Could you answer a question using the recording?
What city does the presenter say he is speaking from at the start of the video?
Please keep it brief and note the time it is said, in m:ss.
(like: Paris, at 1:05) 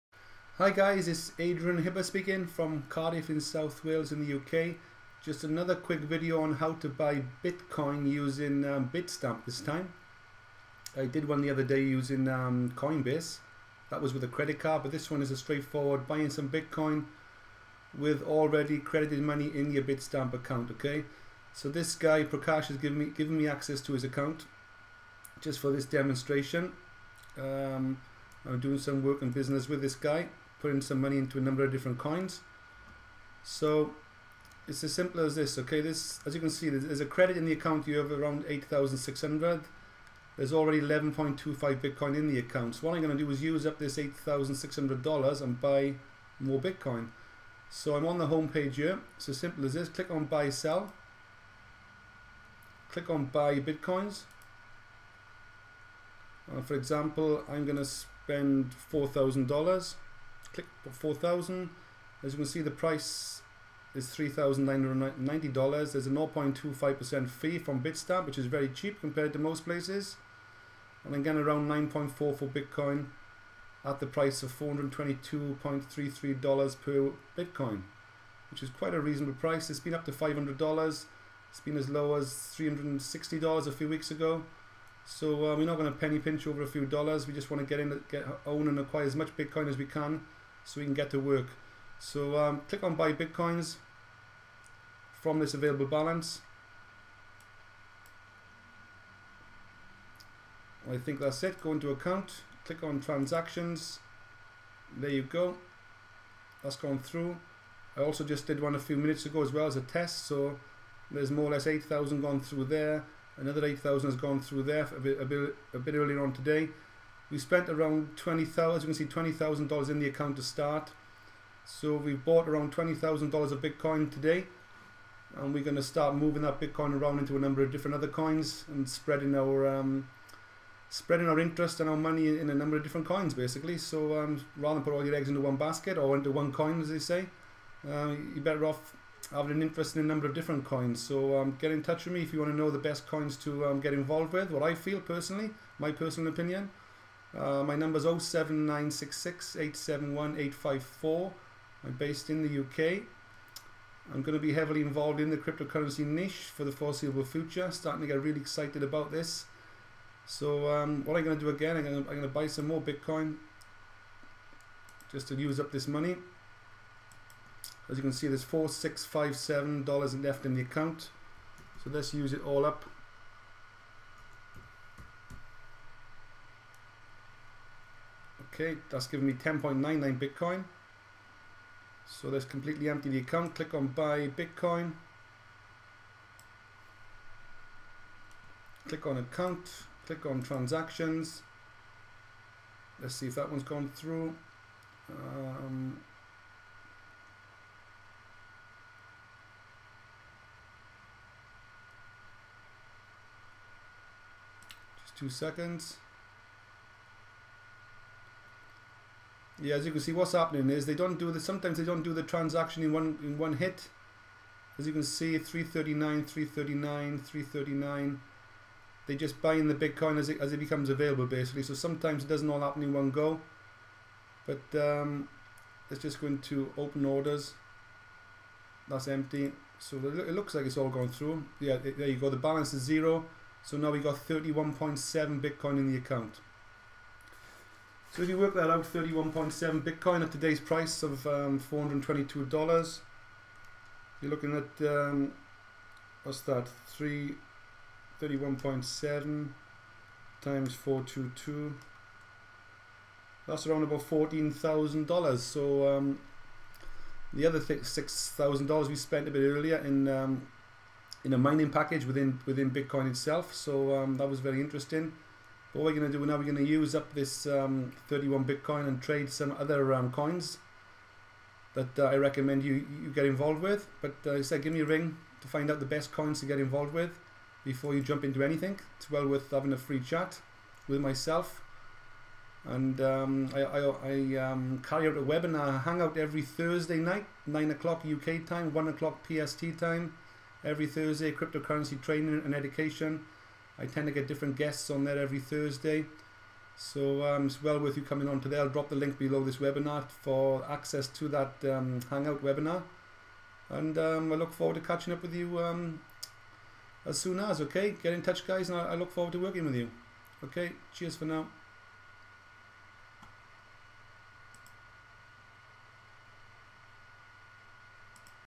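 Cardiff, at 0:02.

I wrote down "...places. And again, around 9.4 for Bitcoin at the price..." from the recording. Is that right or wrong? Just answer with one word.
right.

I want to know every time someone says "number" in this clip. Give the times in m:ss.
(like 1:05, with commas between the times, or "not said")
0:31, 2:07, 2:12, 2:20, 2:27.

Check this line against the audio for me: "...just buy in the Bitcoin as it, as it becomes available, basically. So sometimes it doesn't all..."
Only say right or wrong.
right.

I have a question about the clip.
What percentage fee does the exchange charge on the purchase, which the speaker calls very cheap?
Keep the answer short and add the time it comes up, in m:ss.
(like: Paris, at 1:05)
0.25%, at 1:06.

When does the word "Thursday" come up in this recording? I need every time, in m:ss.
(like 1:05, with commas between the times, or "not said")
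4:46, 4:50, 4:55.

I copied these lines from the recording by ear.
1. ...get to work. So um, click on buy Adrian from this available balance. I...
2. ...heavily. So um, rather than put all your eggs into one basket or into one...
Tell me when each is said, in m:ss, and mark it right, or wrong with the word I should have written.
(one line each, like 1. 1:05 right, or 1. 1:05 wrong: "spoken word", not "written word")
1. 1:30 wrong: "Bitcoins", not "Adrian"
2. 2:13 wrong: "basically", not "heavily".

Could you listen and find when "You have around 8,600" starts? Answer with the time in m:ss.
0:37.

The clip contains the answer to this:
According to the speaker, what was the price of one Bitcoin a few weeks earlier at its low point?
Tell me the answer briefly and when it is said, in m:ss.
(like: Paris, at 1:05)
$360, at 1:22.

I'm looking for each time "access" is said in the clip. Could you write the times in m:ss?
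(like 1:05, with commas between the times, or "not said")
0:23, 5:00.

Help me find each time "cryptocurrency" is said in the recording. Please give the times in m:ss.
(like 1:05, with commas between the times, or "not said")
2:35, 4:51.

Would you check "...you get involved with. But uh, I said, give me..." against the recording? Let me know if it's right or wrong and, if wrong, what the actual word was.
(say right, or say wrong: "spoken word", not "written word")
right.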